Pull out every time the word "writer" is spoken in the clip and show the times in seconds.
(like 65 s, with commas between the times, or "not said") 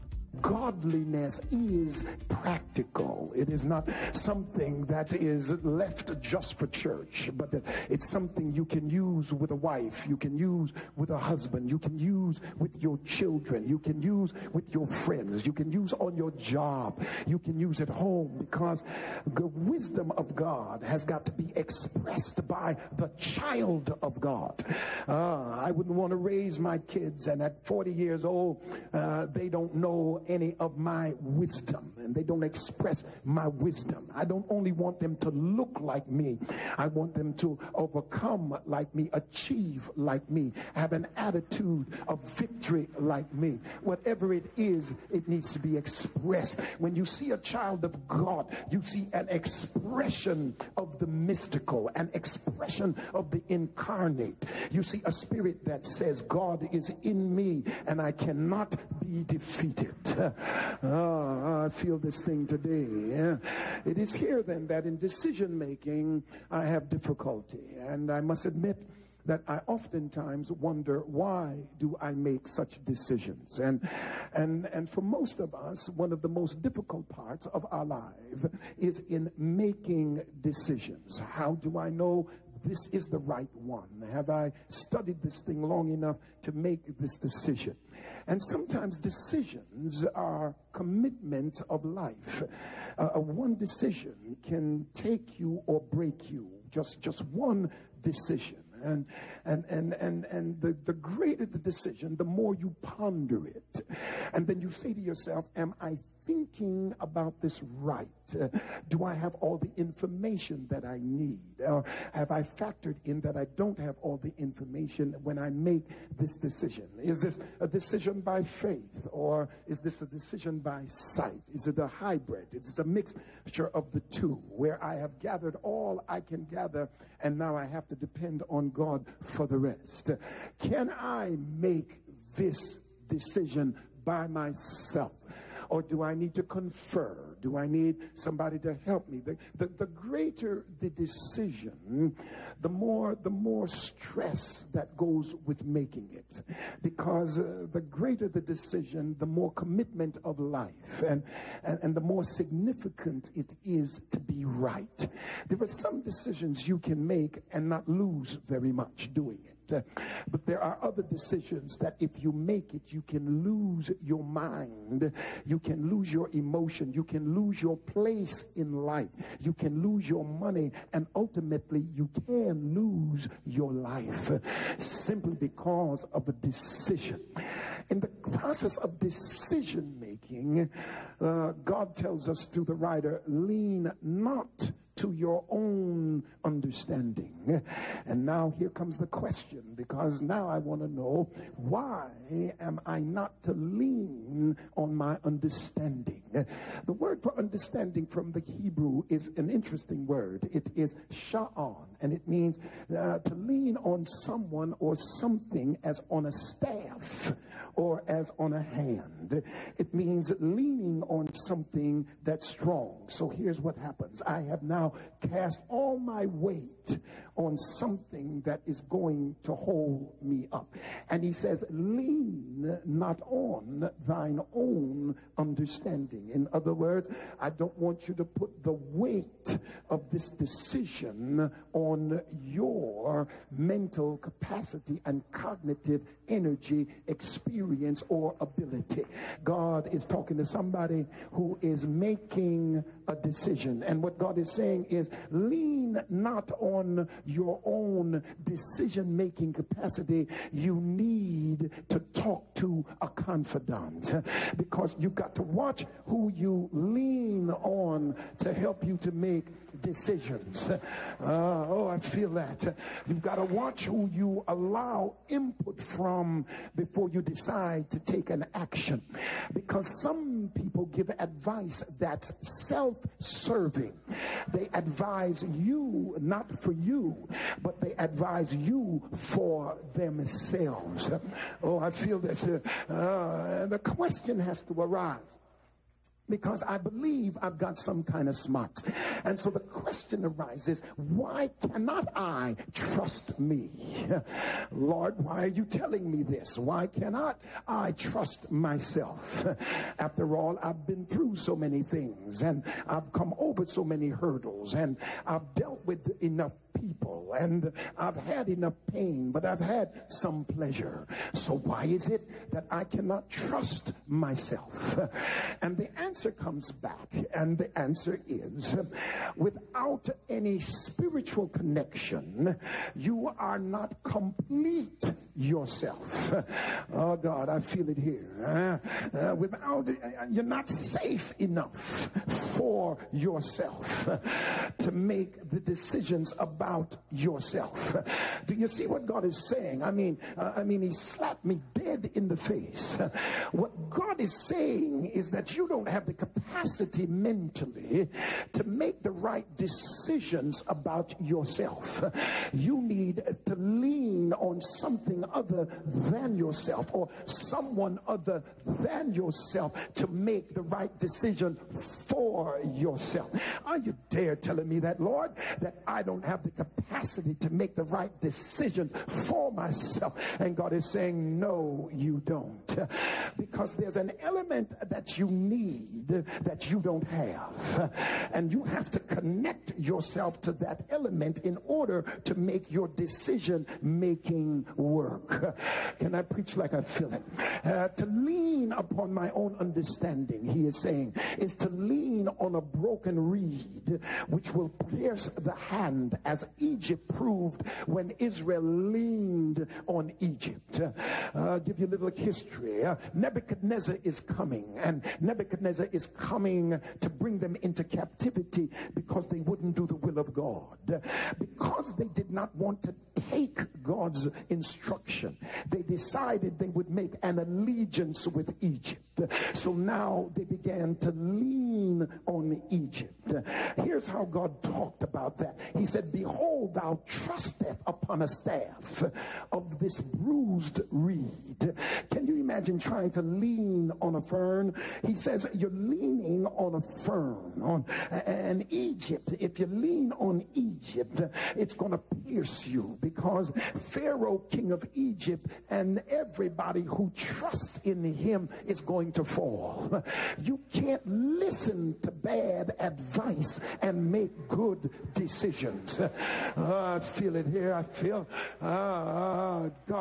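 182 s.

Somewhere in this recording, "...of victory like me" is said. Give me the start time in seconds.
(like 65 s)
42 s.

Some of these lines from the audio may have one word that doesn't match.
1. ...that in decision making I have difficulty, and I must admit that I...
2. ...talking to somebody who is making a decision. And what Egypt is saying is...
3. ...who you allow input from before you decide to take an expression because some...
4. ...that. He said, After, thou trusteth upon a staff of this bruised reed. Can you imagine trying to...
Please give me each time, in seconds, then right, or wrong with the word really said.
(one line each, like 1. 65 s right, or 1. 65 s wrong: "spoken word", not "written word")
1. 64 s right
2. 240 s wrong: "God", not "Egypt"
3. 263 s wrong: "action", not "expression"
4. 425 s wrong: "Behold", not "After".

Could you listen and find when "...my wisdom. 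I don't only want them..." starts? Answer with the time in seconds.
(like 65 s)
33 s.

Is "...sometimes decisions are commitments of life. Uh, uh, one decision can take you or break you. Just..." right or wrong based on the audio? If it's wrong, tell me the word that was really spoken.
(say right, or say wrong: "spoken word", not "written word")
right.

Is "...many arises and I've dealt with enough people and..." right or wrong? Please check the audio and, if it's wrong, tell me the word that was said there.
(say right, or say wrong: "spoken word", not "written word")
wrong: "hurdles", not "arises".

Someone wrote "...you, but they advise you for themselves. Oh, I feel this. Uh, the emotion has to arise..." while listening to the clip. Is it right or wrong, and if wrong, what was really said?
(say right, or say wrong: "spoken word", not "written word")
wrong: "question", not "emotion".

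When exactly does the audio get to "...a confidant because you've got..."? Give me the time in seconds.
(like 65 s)
253 s.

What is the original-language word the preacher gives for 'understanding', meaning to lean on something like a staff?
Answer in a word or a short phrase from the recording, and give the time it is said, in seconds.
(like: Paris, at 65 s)
sha'an, at 201 s.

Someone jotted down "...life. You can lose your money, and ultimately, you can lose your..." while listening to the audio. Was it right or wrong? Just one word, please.
right.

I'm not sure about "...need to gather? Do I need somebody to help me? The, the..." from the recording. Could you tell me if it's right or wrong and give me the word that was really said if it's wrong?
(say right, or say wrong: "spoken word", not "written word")
wrong: "confer", not "gather".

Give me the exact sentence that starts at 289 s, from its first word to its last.
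And so the question arises, why cannot I trust me?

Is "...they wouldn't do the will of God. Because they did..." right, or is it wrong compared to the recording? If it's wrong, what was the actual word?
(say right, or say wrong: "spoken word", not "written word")
right.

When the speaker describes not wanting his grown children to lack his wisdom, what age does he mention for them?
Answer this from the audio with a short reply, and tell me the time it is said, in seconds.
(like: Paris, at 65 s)
40, at 27 s.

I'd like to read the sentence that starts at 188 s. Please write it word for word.
And now here comes the question, because now I want to know why am I not to lean on my understanding?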